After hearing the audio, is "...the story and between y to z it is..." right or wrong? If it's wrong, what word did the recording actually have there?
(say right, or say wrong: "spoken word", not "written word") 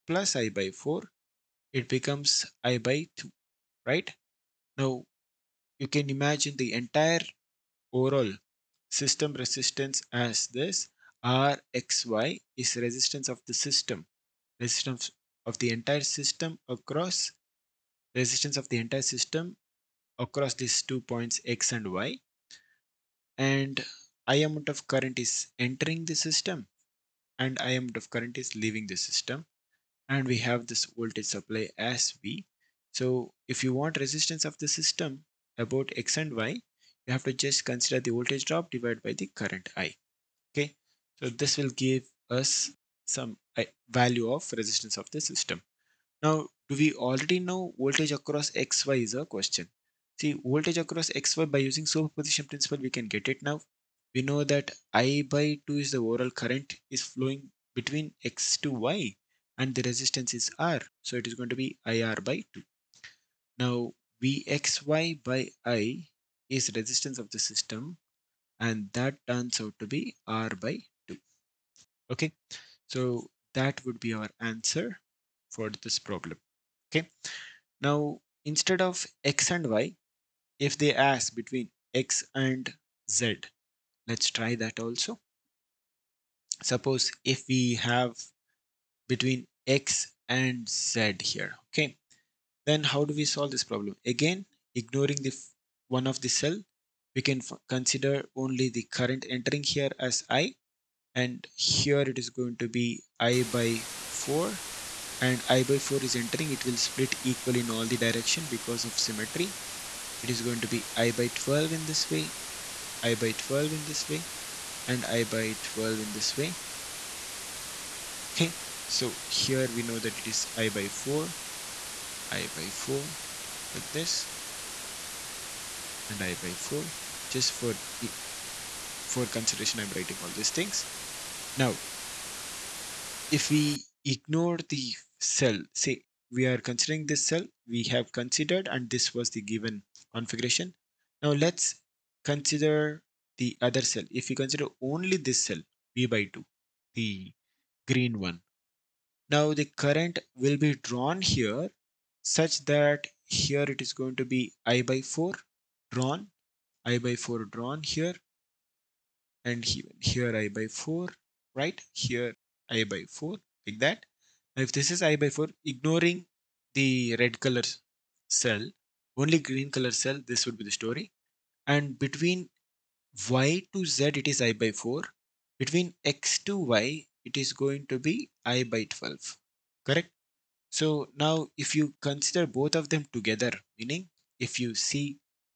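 right.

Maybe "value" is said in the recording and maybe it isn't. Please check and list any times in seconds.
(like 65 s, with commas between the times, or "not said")
43 s.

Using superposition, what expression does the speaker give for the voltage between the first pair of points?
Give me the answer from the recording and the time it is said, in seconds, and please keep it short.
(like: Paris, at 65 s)
IR/2, at 61 s.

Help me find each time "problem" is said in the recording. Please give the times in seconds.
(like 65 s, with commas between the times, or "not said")
75 s, 93 s.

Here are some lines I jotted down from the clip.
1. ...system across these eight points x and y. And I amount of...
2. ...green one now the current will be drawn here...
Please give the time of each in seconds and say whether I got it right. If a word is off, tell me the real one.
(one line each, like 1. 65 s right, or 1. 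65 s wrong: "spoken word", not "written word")
1. 19 s wrong: "two", not "eight"
2. 147 s right.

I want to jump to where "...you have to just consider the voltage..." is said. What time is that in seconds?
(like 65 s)
37 s.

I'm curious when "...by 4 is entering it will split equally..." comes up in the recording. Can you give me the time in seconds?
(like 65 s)
105 s.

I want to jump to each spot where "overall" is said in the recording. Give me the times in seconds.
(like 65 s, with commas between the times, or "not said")
7 s, 56 s.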